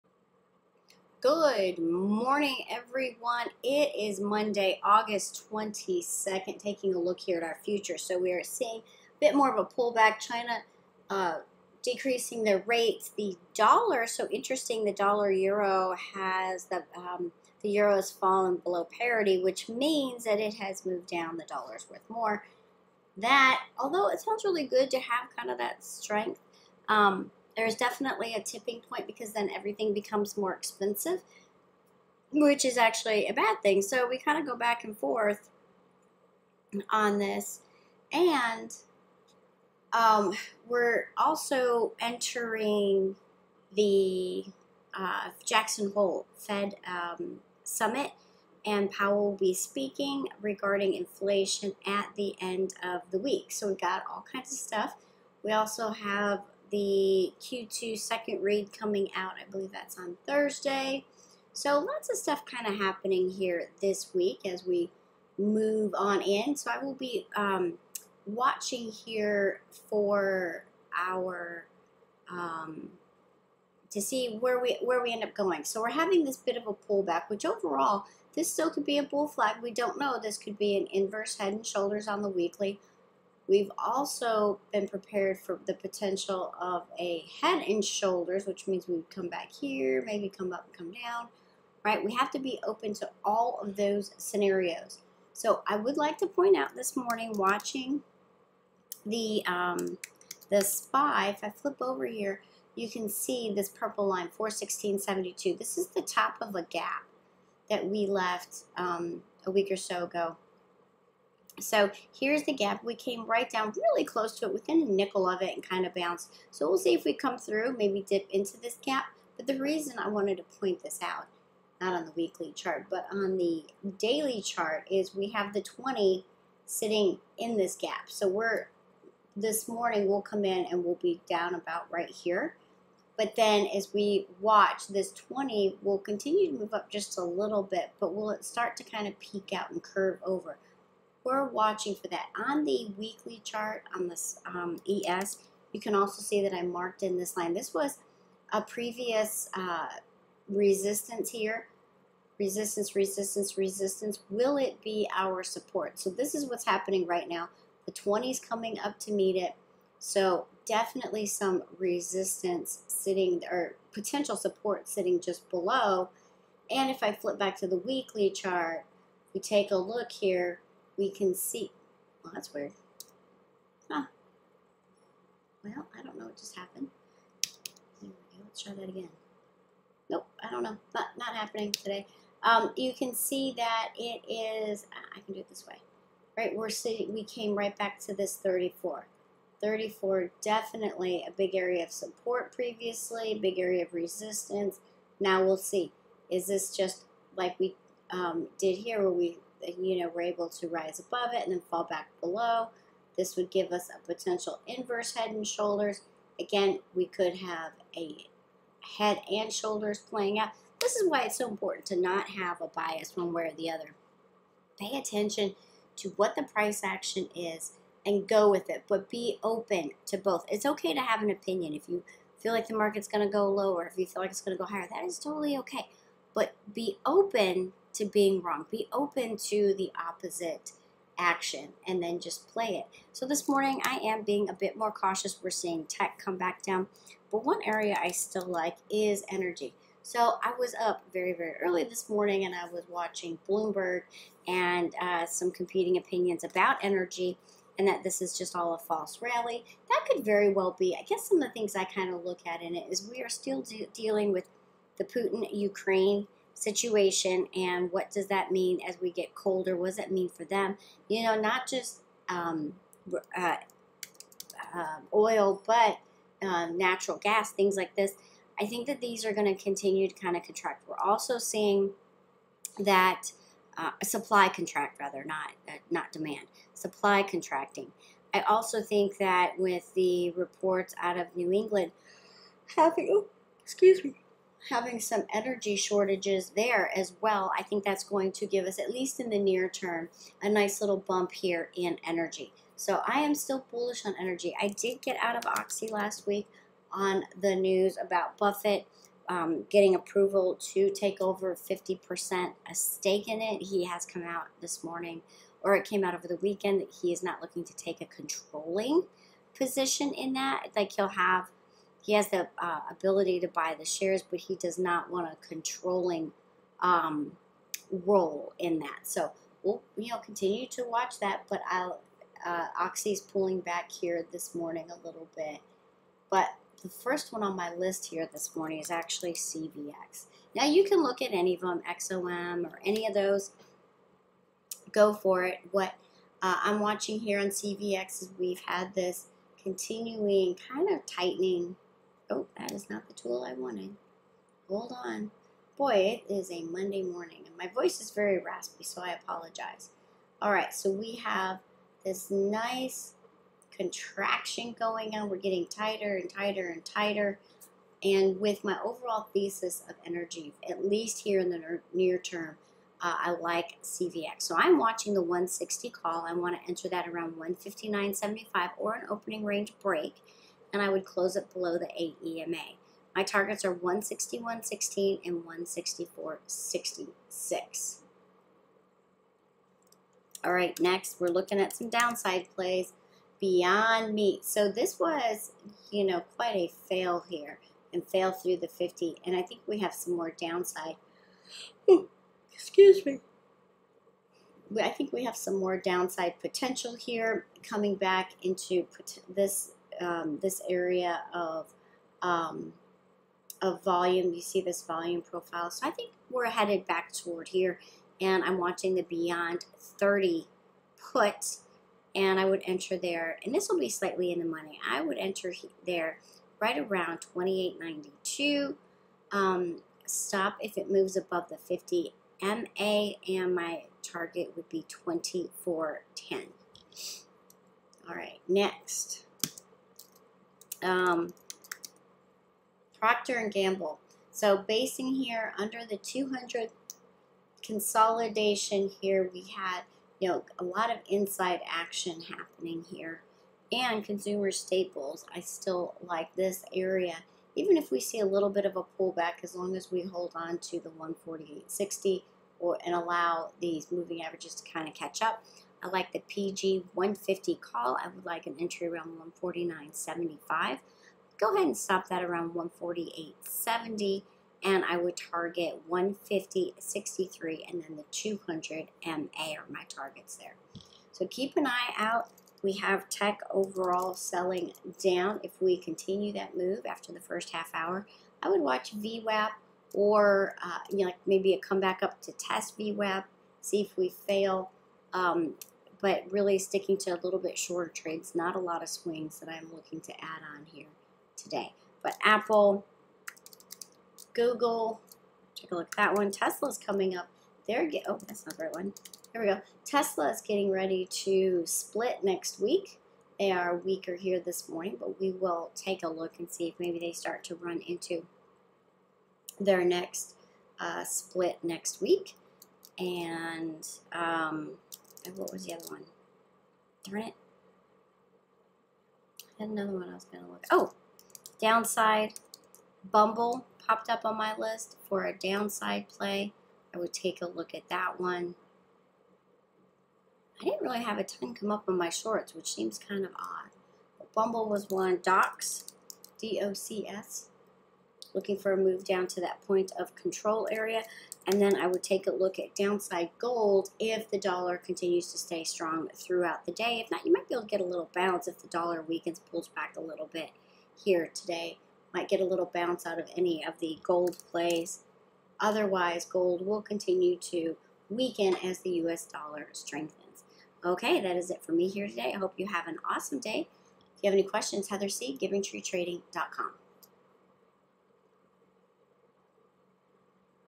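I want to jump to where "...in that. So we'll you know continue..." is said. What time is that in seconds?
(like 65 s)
318 s.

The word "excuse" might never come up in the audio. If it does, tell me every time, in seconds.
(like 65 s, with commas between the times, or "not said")
283 s, 392 s.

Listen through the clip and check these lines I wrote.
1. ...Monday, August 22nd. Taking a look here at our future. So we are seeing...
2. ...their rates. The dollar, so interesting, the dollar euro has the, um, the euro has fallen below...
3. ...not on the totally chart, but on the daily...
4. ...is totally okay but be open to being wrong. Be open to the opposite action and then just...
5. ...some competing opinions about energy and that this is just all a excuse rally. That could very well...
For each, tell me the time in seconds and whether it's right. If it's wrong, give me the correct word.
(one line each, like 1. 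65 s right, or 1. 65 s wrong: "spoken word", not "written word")
1. 4 s right
2. 12 s right
3. 121 s wrong: "weekly", not "totally"
4. 225 s right
5. 245 s wrong: "false", not "excuse".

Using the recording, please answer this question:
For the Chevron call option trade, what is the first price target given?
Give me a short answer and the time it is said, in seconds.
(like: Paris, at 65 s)
161.16, at 373 s.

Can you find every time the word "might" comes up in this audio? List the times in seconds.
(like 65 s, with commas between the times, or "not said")
547 s, 552 s.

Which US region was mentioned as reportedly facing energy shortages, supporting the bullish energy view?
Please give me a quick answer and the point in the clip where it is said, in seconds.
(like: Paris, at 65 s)
New England, at 281 s.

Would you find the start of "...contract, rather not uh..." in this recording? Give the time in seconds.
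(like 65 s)
274 s.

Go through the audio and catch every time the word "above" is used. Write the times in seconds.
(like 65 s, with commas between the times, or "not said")
200 s, 421 s.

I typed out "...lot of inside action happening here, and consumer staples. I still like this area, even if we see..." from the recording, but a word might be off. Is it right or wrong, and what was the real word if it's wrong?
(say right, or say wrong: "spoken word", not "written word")
right.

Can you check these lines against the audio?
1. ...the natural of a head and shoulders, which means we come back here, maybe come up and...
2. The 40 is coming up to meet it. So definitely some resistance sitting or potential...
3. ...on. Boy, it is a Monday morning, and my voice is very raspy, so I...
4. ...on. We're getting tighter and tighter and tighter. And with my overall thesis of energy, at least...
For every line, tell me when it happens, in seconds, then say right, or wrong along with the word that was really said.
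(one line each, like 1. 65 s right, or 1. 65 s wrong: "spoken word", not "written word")
1. 85 s wrong: "potential", not "natural"
2. 157 s wrong: "20", not "40"
3. 345 s right
4. 355 s right.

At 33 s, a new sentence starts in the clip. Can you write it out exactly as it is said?
So we kind of go back and forth on this.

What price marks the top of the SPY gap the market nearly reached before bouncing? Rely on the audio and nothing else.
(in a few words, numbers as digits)
416.72.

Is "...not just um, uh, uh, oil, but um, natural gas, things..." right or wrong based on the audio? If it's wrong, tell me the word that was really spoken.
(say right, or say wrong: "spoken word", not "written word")
right.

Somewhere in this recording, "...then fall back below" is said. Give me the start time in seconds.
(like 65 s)
201 s.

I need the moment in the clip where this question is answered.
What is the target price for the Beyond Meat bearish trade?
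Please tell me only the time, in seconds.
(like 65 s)
425 s.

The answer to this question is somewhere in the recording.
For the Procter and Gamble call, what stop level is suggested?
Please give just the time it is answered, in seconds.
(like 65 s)
462 s.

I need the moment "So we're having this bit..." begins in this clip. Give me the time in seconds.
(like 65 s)
75 s.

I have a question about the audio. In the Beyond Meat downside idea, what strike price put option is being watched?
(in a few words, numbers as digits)
30.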